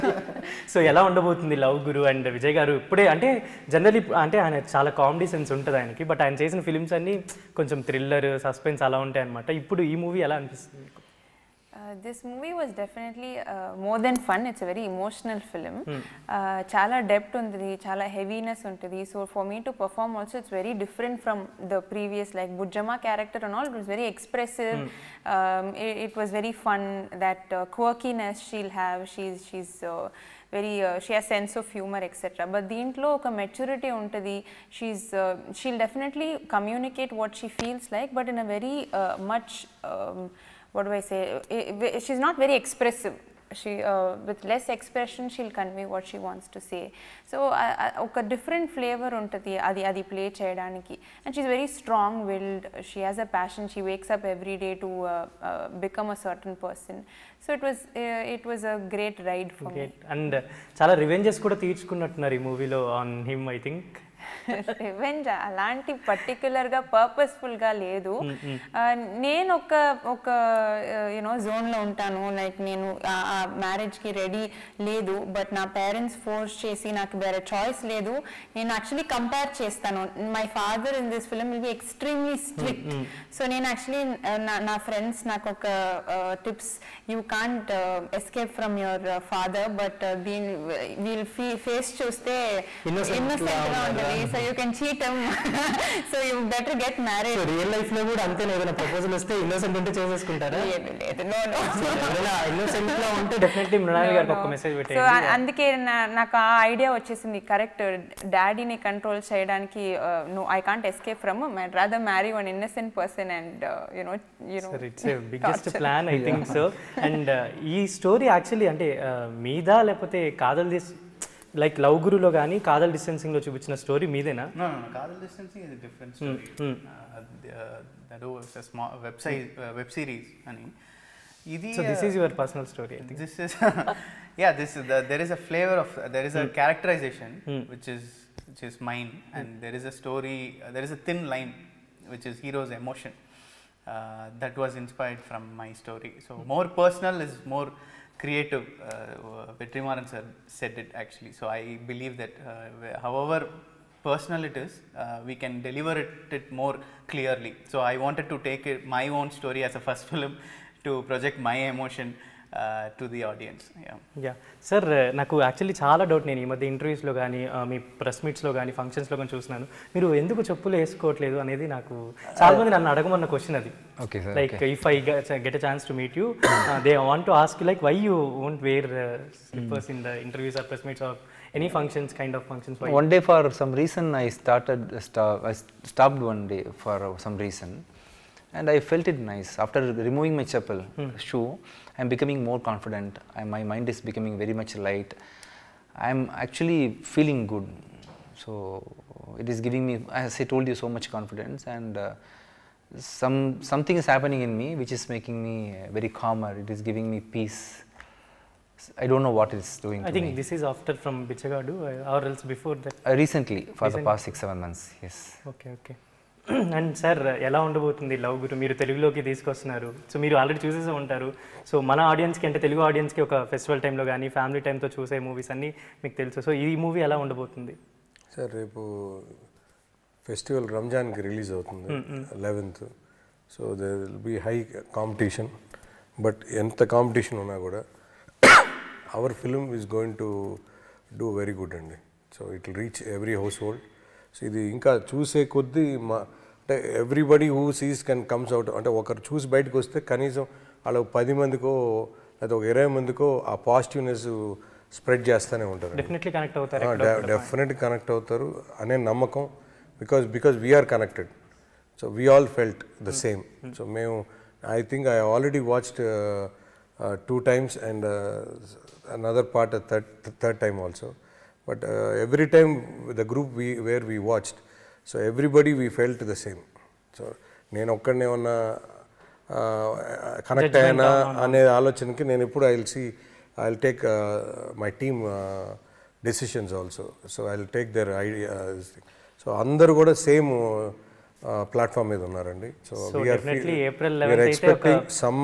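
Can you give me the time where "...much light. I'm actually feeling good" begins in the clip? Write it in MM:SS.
03:14.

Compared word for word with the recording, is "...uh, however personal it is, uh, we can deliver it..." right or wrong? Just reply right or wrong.
right.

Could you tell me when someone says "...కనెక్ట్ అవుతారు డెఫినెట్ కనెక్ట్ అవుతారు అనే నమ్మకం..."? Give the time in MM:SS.
04:16.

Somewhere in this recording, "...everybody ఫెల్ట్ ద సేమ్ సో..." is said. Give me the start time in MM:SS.
04:35.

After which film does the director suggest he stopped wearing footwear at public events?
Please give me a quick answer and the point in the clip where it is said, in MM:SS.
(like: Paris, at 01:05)
Bichagadu, at 03:31.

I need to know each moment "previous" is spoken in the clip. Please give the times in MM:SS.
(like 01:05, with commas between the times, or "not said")
00:21.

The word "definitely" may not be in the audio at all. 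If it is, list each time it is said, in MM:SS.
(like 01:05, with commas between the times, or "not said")
00:12, 00:35.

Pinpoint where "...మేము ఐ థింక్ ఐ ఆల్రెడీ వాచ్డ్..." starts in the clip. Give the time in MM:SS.
04:23.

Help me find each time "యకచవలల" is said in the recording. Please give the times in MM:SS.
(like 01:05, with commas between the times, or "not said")
01:18, 01:23, 01:58, 02:45.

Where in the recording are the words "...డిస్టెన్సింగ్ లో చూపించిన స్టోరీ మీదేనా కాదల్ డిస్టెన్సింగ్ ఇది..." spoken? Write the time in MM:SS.
02:02.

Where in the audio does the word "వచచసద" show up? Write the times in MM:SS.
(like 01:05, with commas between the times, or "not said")
01:46.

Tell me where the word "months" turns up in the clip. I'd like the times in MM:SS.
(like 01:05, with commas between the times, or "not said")
03:34.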